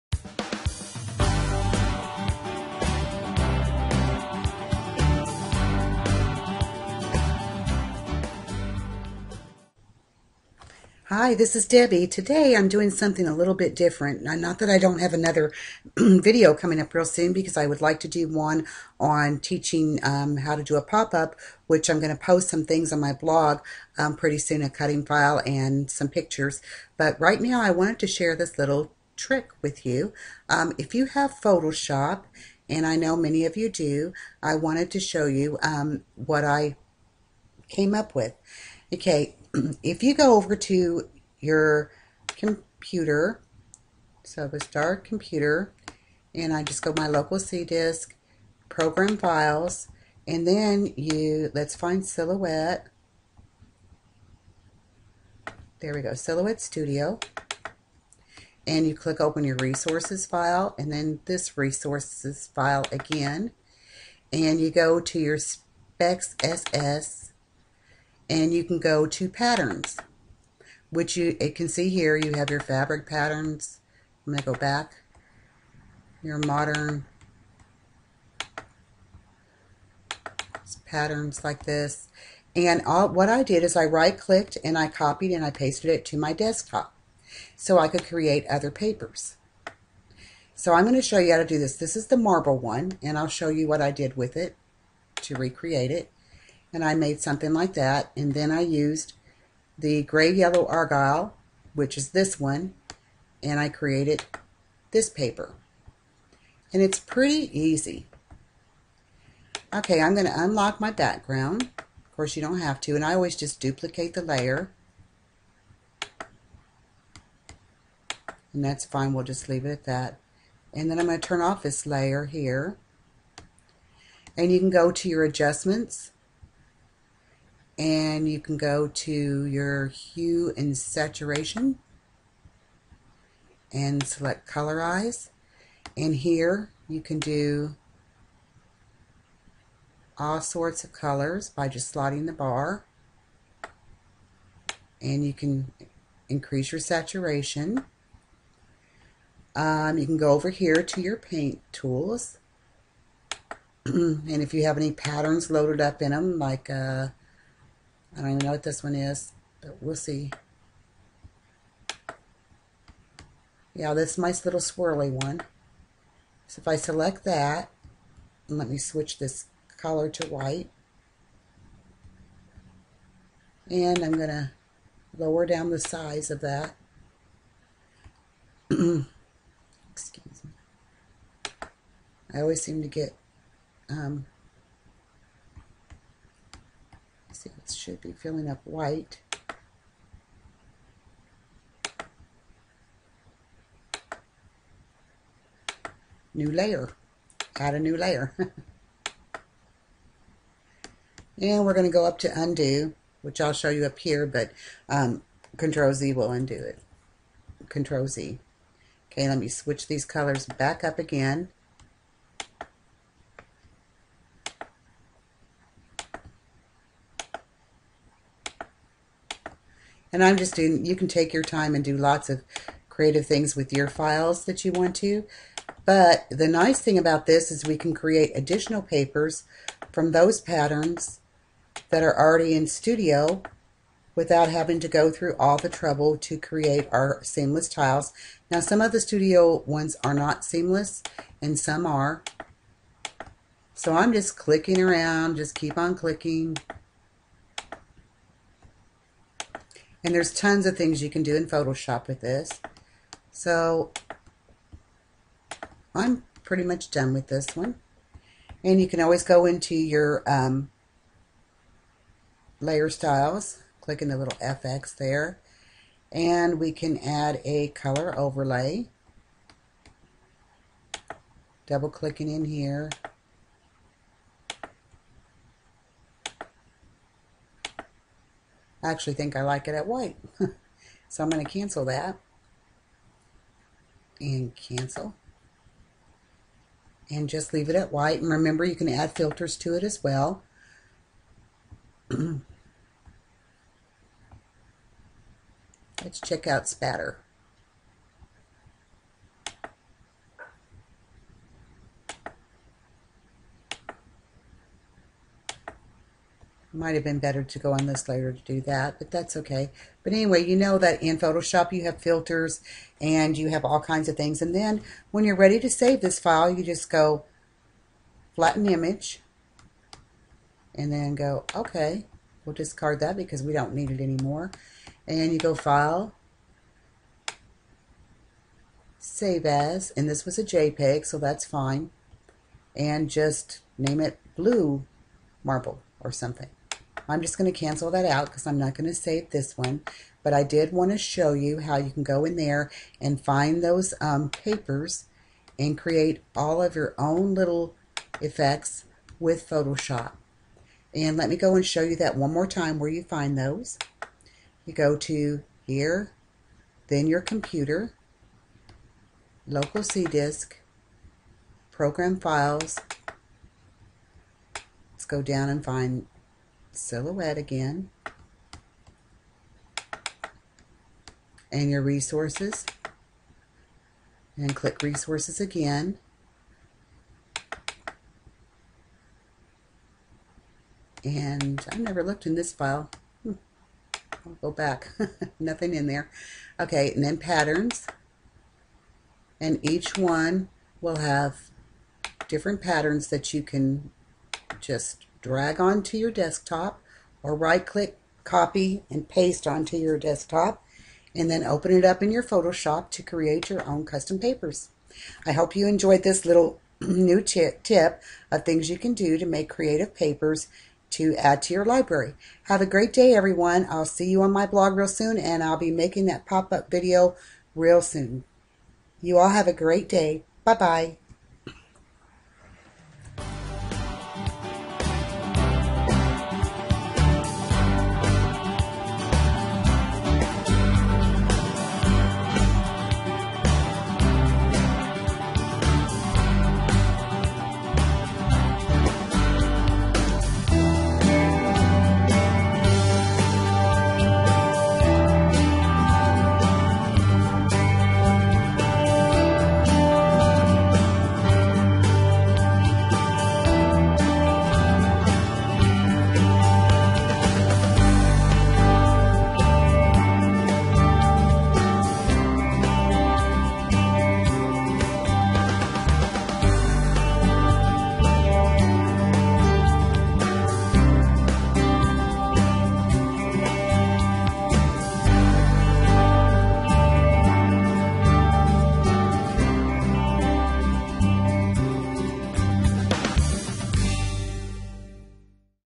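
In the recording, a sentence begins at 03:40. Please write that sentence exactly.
And I'm just doing, you can take your time and do lots of creative things with your files that you want to.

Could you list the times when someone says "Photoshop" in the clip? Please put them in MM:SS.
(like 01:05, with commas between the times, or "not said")
00:31, 04:11, 05:11, 05:49, 06:42.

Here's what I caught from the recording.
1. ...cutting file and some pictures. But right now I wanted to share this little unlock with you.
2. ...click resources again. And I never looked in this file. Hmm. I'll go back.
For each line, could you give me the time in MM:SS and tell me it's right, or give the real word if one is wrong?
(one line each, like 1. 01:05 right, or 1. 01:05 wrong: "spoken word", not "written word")
1. 00:24 wrong: "trick", not "unlock"
2. 06:14 right.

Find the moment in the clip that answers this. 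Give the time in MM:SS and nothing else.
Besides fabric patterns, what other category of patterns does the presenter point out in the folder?
01:16.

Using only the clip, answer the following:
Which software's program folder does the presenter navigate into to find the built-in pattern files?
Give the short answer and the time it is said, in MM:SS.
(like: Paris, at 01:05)
Silhouette Studio, at 00:56.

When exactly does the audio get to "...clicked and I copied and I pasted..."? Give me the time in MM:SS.
01:24.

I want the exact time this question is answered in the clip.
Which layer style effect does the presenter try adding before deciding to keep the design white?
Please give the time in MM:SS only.
04:27.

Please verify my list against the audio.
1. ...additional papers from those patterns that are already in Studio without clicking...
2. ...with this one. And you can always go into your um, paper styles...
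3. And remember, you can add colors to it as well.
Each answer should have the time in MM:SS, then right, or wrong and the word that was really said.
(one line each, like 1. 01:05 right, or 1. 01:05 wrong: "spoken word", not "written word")
1. 03:48 wrong: "having", not "clicking"
2. 04:17 wrong: "layer", not "paper"
3. 04:48 wrong: "filters", not "colors".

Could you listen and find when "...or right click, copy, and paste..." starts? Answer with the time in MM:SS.
06:37.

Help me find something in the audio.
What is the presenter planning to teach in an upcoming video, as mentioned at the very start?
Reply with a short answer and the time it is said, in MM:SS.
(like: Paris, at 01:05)
How to do a pop-up, at 00:20.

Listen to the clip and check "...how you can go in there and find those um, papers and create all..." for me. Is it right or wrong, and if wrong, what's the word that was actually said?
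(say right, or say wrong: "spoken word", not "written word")
right.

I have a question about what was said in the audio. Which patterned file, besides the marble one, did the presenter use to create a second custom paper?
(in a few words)
Gray yellow argyle.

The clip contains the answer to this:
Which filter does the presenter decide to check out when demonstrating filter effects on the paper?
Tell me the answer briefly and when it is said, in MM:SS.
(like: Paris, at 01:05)
Spatter, at 04:56.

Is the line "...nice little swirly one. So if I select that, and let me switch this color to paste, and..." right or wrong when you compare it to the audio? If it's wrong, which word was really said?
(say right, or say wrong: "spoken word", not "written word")
wrong: "white", not "paste".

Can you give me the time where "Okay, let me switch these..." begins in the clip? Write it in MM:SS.
03:29.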